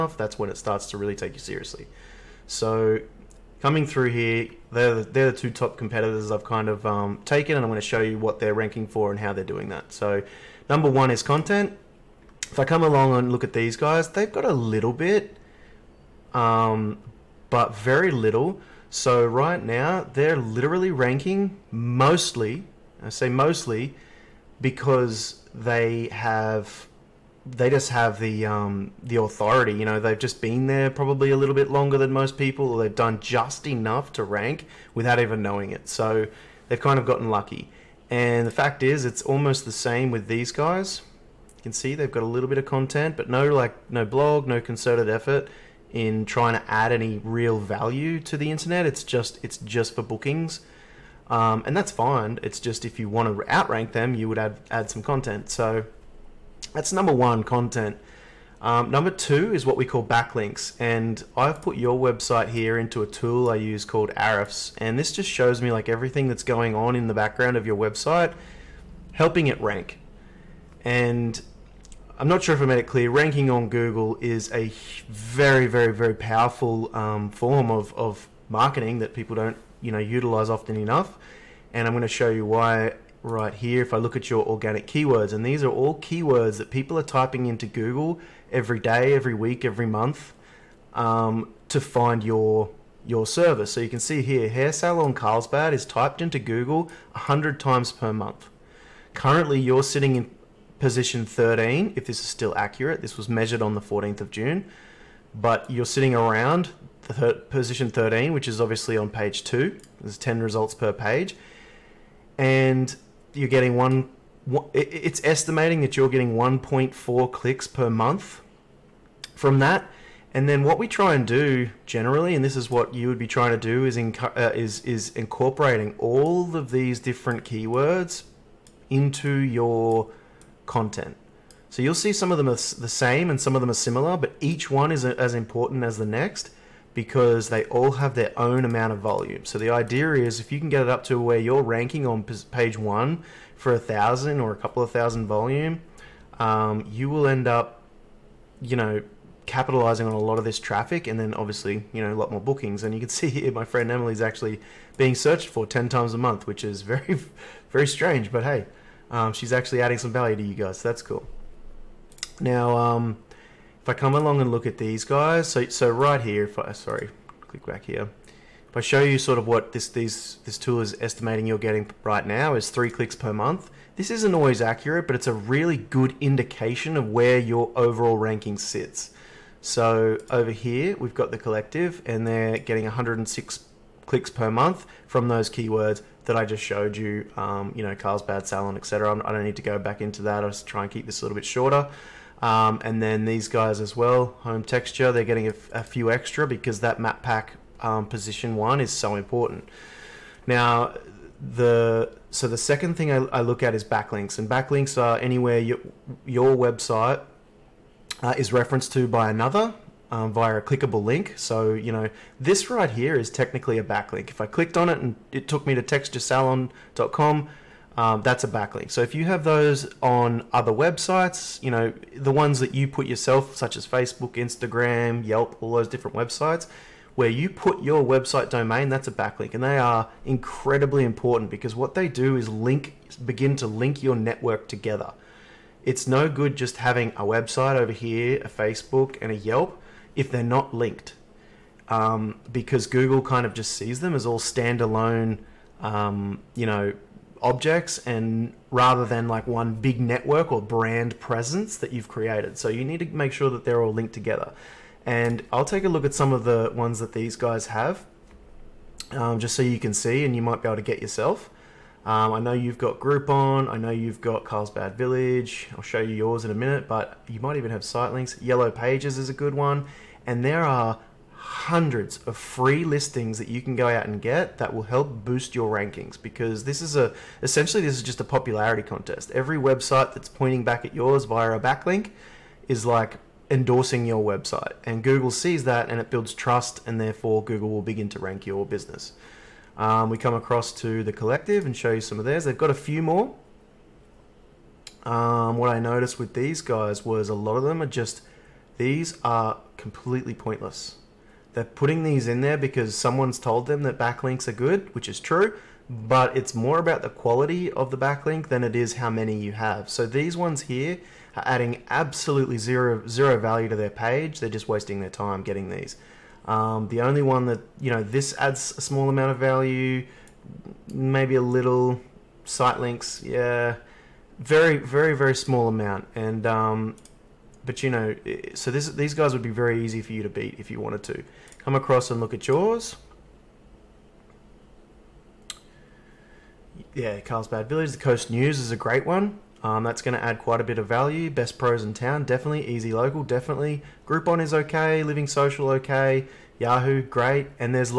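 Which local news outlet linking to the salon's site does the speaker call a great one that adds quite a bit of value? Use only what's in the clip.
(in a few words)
The Coast News.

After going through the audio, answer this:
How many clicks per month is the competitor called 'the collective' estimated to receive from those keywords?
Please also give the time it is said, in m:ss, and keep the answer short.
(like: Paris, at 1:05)
106, at 3:02.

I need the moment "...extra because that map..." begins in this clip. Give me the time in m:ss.
3:16.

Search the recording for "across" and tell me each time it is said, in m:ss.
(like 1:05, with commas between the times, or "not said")
4:50, 5:31.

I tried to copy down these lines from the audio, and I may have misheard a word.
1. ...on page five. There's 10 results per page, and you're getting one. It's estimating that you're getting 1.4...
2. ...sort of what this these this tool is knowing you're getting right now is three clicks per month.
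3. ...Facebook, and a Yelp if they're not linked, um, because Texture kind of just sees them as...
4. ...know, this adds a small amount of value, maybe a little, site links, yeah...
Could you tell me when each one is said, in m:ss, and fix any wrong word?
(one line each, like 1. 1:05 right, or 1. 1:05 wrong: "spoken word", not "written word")
1. 1:48 wrong: "two", not "five"
2. 2:49 wrong: "estimating", not "knowing"
3. 3:58 wrong: "Google", not "Texture"
4. 5:17 right.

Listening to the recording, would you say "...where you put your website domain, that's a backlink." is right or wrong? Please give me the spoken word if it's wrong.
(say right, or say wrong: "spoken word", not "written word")
right.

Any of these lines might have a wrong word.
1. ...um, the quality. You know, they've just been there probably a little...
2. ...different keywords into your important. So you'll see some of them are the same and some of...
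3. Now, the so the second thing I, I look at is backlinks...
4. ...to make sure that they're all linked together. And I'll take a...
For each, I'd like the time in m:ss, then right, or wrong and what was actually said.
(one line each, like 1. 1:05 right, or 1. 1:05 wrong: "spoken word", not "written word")
1. 0:28 wrong: "authority", not "quality"
2. 2:06 wrong: "content", not "important"
3. 3:20 right
4. 4:13 right.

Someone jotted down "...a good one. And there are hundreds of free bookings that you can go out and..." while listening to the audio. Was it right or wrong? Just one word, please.
wrong.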